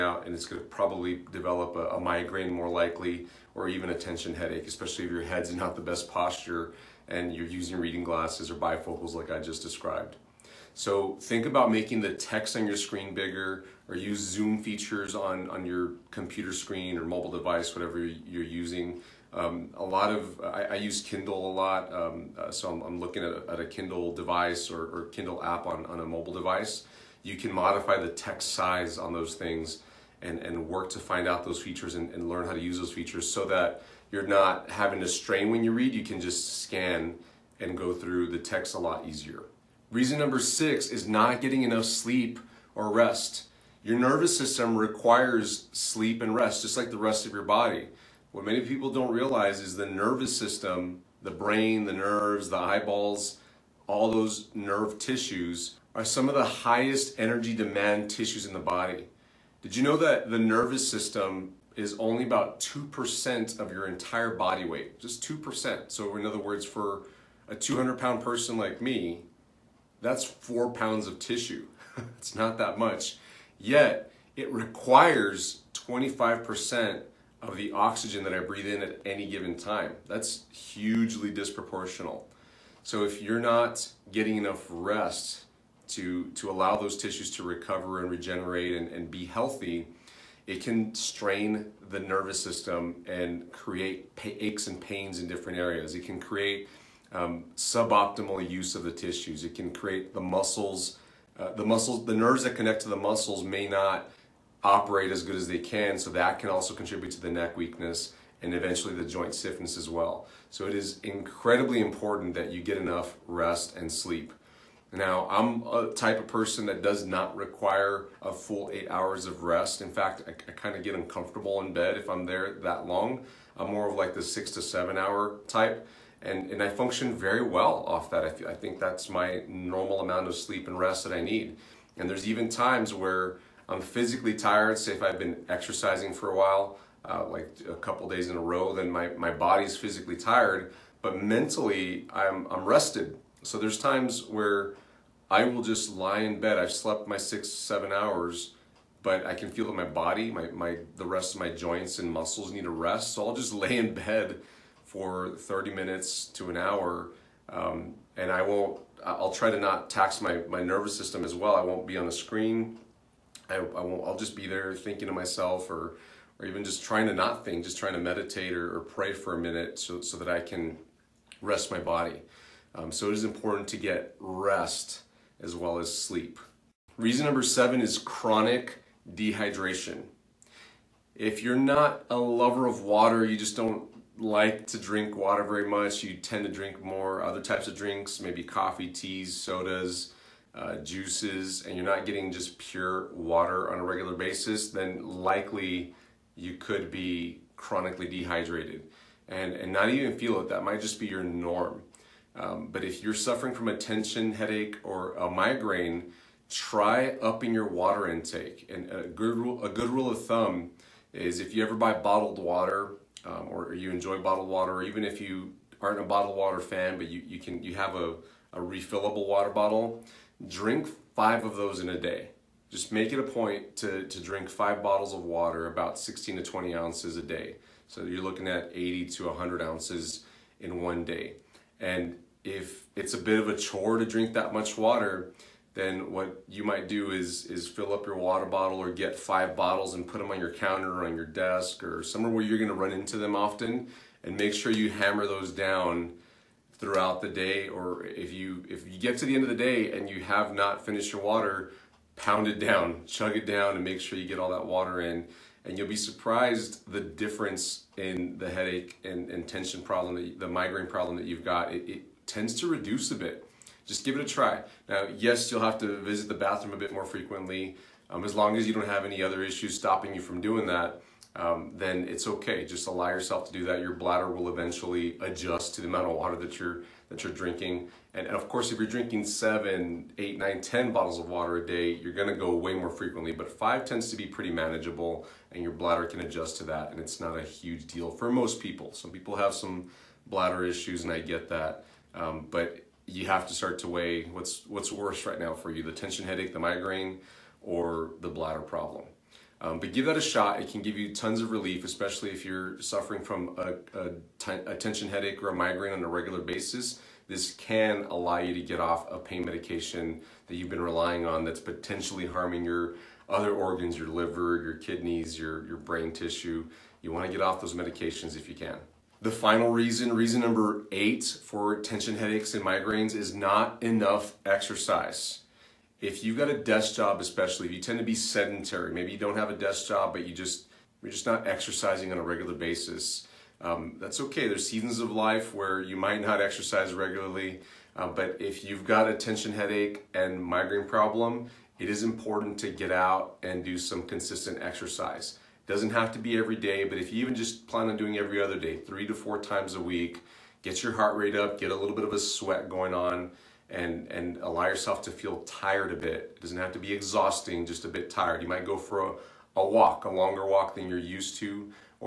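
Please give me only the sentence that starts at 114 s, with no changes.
Now, I'm a type of person that does not require a full eight hours of rest.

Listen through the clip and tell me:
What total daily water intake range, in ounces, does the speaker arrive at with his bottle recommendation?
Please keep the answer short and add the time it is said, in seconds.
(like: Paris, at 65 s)
80 to 100 ounces, at 228 s.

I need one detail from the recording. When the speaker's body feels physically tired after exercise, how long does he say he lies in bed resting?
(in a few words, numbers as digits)
30 minutes to an hour.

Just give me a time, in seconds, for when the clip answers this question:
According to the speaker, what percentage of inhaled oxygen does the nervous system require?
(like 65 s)
75 s.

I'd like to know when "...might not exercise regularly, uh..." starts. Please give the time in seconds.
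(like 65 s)
335 s.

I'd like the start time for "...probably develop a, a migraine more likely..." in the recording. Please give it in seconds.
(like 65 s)
0 s.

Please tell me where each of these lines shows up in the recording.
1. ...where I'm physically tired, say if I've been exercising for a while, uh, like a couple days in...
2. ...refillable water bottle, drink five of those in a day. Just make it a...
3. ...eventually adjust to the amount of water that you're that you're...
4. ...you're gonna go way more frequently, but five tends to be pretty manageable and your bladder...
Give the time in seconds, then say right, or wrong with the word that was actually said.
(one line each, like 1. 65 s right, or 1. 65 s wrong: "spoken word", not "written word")
1. 132 s right
2. 218 s right
3. 274 s right
4. 281 s right.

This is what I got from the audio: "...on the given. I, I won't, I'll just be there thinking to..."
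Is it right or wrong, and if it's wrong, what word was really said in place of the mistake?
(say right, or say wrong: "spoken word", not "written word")
wrong: "screen", not "given".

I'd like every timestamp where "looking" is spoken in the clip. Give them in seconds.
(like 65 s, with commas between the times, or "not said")
22 s, 228 s.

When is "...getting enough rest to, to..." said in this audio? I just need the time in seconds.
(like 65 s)
84 s.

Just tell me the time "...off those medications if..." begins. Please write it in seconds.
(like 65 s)
317 s.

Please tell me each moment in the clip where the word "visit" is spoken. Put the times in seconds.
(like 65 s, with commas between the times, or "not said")
265 s.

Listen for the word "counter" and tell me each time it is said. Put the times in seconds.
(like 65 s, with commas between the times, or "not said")
240 s.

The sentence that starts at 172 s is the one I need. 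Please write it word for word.
Um, so it is important to get rest as well as sleep.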